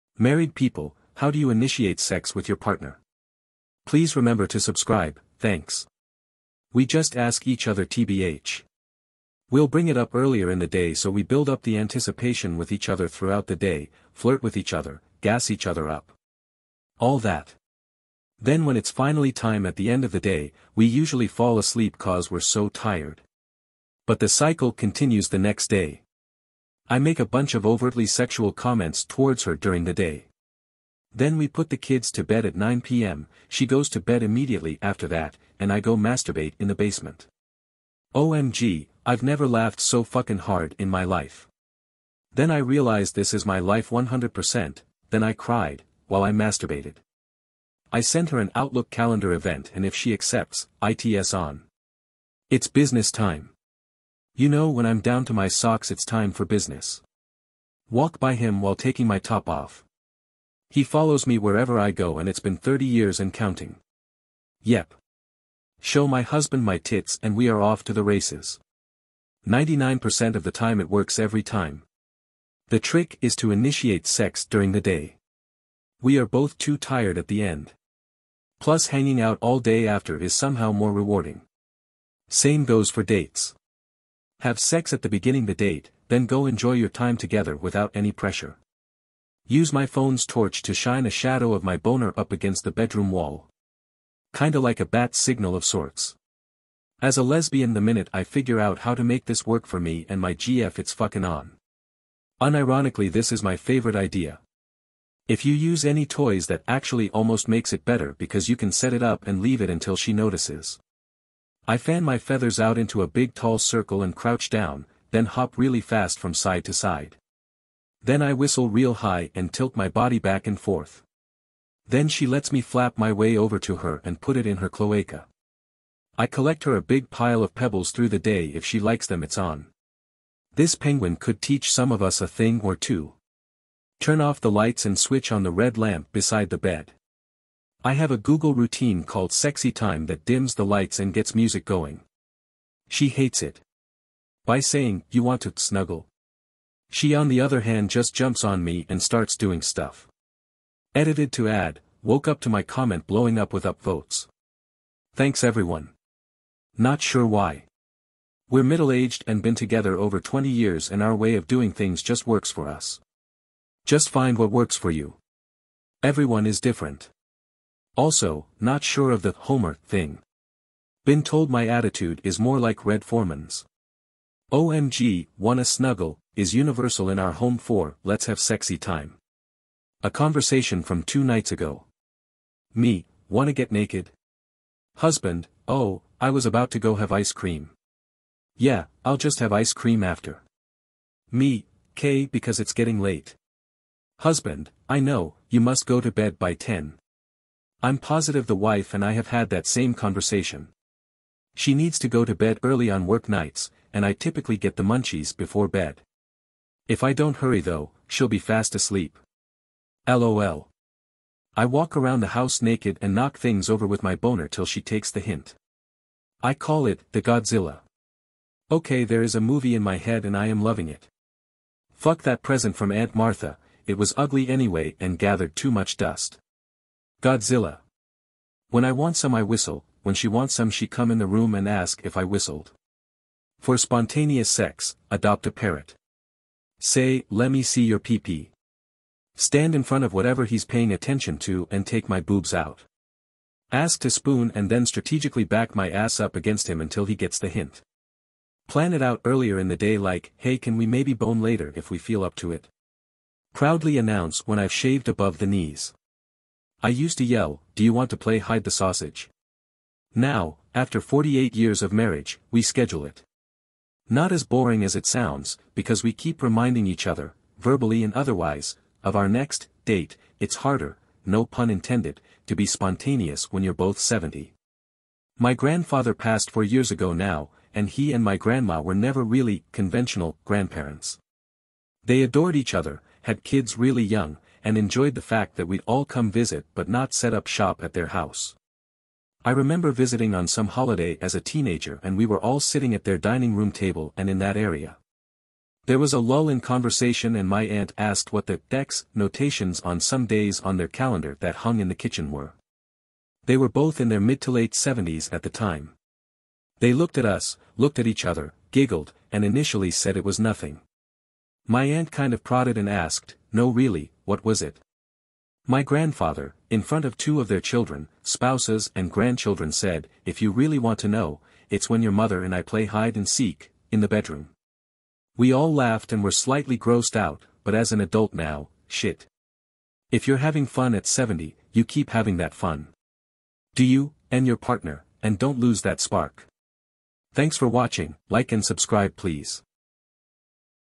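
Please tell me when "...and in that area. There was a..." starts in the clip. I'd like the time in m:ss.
4:54.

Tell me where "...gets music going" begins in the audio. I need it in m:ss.
2:21.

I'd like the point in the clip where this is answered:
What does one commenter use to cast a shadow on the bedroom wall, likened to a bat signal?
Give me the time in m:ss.
1:29.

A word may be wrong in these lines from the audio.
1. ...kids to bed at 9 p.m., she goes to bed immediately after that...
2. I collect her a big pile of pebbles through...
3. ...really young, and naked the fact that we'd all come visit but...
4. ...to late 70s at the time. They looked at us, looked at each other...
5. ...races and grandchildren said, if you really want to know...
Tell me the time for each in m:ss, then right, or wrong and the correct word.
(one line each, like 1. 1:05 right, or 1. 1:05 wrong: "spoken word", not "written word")
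1. 0:31 right
2. 2:06 right
3. 4:43 wrong: "enjoyed", not "naked"
4. 5:04 right
5. 5:18 wrong: "spouses", not "races".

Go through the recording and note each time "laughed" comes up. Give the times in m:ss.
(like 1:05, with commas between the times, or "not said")
0:39, 5:25.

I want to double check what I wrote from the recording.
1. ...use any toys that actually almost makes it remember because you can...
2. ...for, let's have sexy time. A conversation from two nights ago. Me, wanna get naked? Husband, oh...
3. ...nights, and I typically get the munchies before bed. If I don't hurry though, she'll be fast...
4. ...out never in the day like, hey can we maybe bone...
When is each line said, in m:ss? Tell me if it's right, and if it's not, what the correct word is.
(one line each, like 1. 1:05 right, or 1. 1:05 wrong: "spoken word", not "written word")
1. 1:45 wrong: "better", not "remember"
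2. 2:57 right
3. 3:23 right
4. 4:09 wrong: "earlier", not "never".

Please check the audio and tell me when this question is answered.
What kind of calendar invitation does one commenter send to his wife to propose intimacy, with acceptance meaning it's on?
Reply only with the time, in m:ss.
0:48.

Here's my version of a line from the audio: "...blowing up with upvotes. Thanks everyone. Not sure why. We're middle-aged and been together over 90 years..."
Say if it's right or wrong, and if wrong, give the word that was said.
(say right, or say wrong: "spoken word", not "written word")
wrong: "20", not "90".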